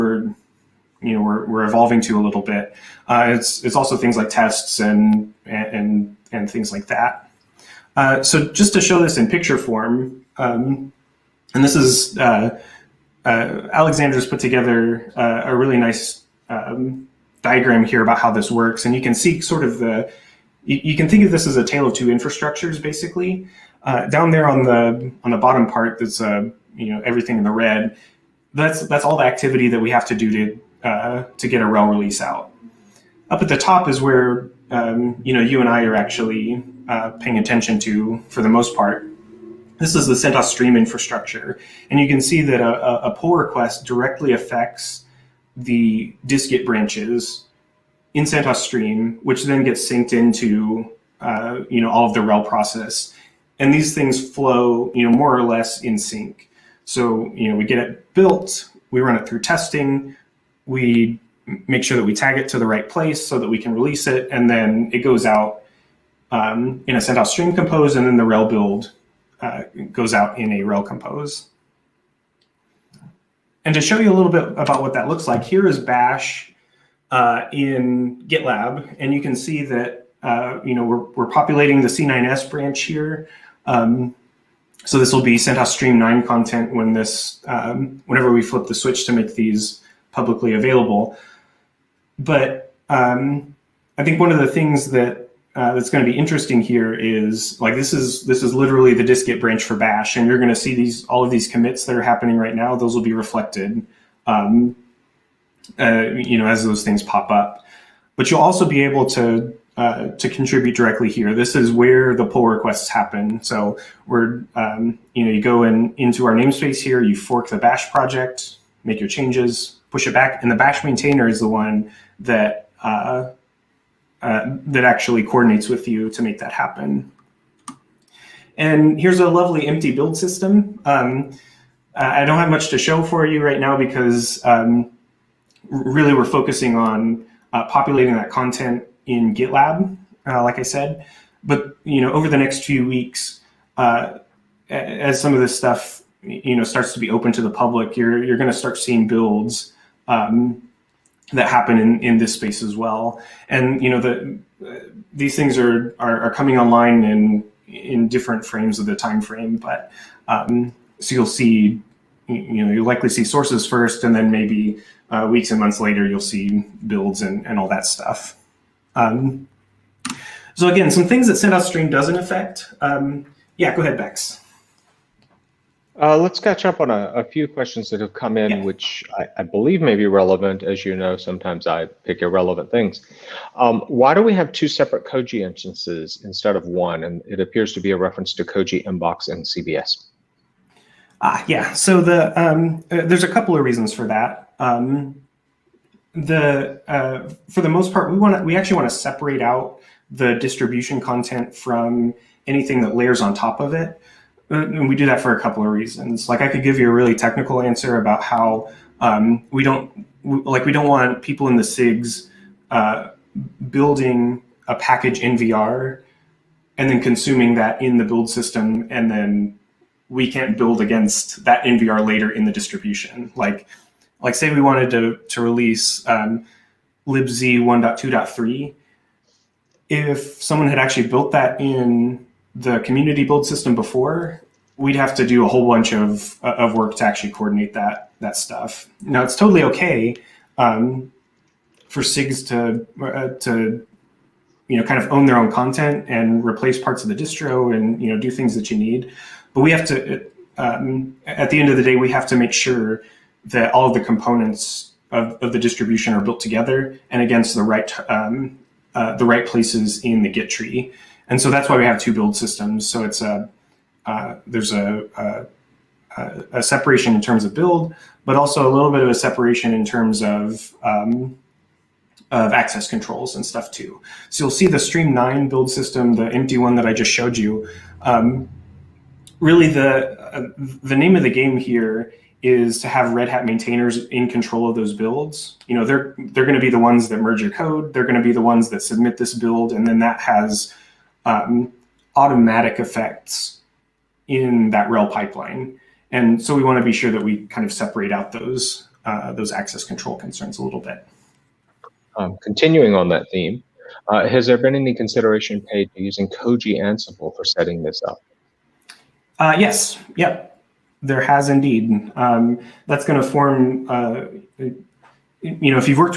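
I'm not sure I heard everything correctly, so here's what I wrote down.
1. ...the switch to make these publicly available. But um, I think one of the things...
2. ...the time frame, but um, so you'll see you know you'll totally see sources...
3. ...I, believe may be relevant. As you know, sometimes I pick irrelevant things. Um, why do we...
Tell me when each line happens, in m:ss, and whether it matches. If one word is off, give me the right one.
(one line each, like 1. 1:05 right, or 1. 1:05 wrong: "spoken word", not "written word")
1. 1:28 right
2. 2:38 wrong: "likely", not "totally"
3. 2:59 right.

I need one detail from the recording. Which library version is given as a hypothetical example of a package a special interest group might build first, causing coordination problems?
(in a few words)
libz 1.2.3.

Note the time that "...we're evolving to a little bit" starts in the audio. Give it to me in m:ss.
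0:01.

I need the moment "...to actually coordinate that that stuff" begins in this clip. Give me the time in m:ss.
3:56.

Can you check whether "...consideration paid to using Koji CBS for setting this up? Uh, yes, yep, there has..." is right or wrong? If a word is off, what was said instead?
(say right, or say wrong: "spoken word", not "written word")
wrong: "Ansible", not "CBS".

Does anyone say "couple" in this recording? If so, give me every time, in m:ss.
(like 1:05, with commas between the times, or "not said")
3:13, 3:25.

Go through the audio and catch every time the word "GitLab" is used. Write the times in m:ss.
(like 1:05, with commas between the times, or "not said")
1:18, 2:19.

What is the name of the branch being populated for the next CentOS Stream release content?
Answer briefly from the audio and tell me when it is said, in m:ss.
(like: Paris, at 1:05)
C9S, at 1:21.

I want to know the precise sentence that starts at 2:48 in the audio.
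Um, so again, some things that CentOS stream doesn't affect.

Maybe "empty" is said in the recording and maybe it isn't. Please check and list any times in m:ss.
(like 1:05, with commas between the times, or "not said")
2:09, 4:36.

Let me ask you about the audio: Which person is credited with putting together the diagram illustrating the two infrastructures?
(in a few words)
Alexander.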